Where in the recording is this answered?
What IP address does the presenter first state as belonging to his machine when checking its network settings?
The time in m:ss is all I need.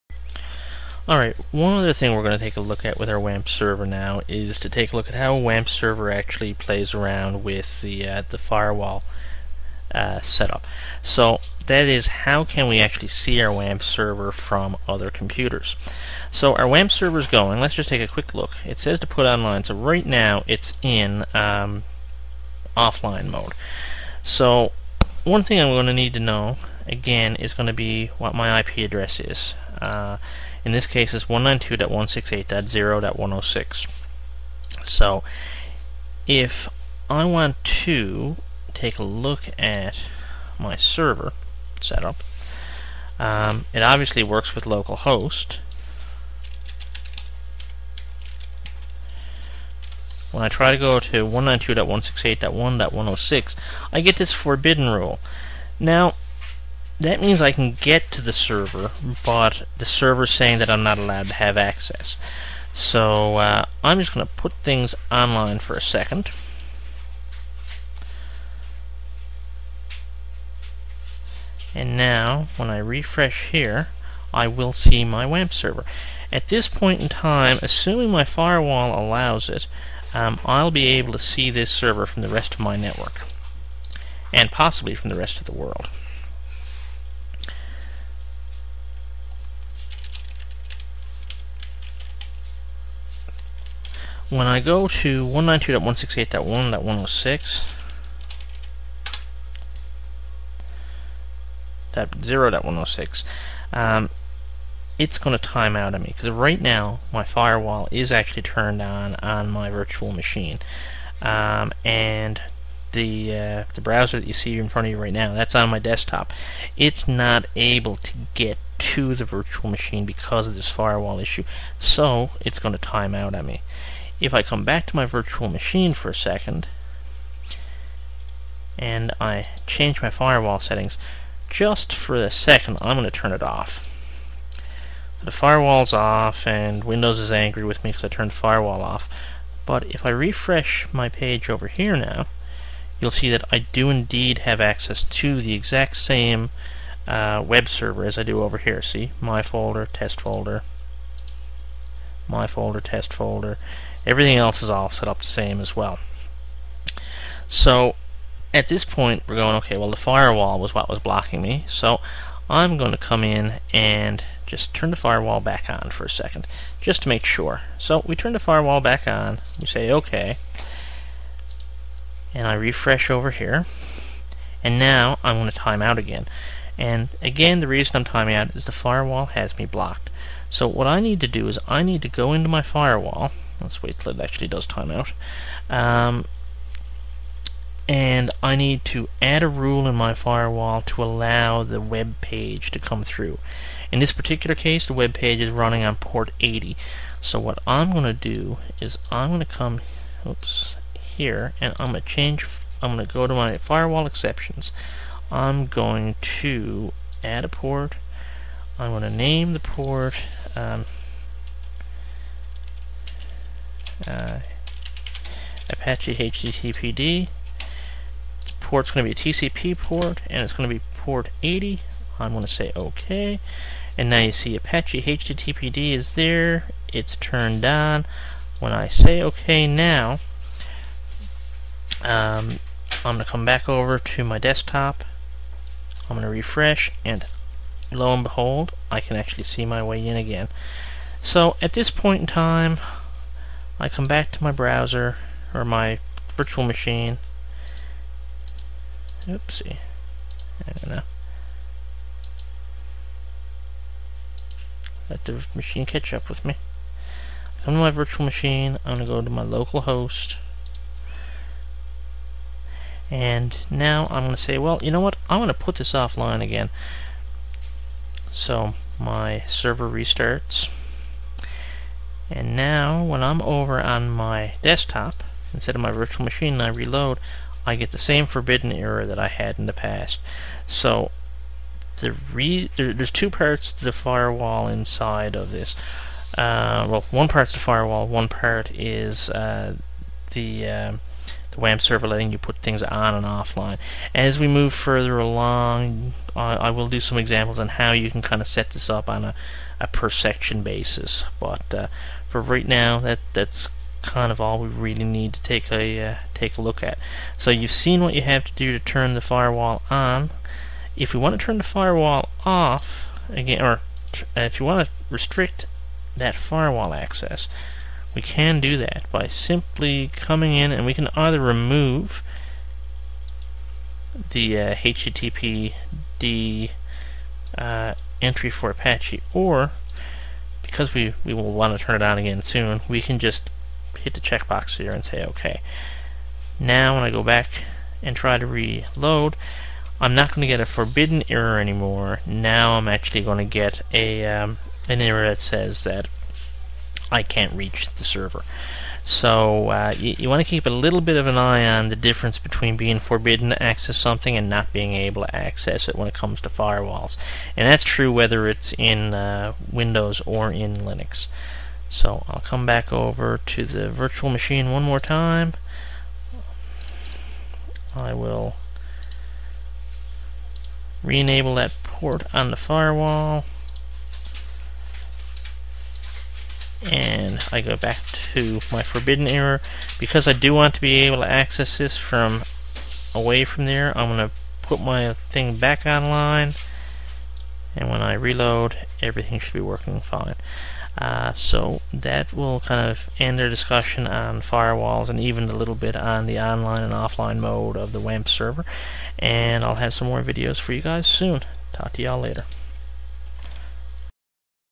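0:31.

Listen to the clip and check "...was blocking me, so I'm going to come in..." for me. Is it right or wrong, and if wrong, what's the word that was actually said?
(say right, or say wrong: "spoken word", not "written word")
right.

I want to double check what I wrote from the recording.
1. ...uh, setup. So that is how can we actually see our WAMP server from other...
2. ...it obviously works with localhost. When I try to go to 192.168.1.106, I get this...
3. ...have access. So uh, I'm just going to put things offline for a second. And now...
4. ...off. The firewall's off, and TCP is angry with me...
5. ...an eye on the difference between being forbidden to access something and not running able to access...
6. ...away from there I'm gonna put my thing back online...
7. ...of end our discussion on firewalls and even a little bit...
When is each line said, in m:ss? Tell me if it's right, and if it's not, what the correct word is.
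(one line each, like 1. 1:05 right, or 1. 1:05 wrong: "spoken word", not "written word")
1. 0:09 right
2. 0:43 right
3. 1:01 wrong: "online", not "offline"
4. 2:13 wrong: "Windows", not "TCP"
5. 5:51 wrong: "being", not "running"
6. 6:23 right
7. 6:32 right.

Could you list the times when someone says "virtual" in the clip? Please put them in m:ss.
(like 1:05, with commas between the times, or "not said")
1:49, 1:59, 2:05, 4:06, 4:17, 4:35, 6:03.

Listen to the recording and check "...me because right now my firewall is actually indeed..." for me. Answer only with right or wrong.
wrong.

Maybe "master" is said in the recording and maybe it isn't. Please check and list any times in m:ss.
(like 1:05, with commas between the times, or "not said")
not said.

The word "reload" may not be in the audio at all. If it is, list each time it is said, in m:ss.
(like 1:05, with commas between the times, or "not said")
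4:36, 5:38, 6:28.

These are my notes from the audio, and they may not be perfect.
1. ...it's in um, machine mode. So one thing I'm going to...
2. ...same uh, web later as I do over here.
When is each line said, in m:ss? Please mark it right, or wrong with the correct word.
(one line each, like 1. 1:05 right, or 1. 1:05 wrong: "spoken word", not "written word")
1. 0:20 wrong: "offline", not "machine"
2. 2:25 wrong: "server", not "later".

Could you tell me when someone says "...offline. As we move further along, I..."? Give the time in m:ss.
4:53.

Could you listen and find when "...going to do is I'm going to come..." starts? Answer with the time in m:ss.
3:17.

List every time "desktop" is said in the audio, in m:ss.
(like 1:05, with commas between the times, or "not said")
1:55, 3:54, 4:34.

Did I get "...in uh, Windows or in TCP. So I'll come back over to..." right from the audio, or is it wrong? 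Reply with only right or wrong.
wrong.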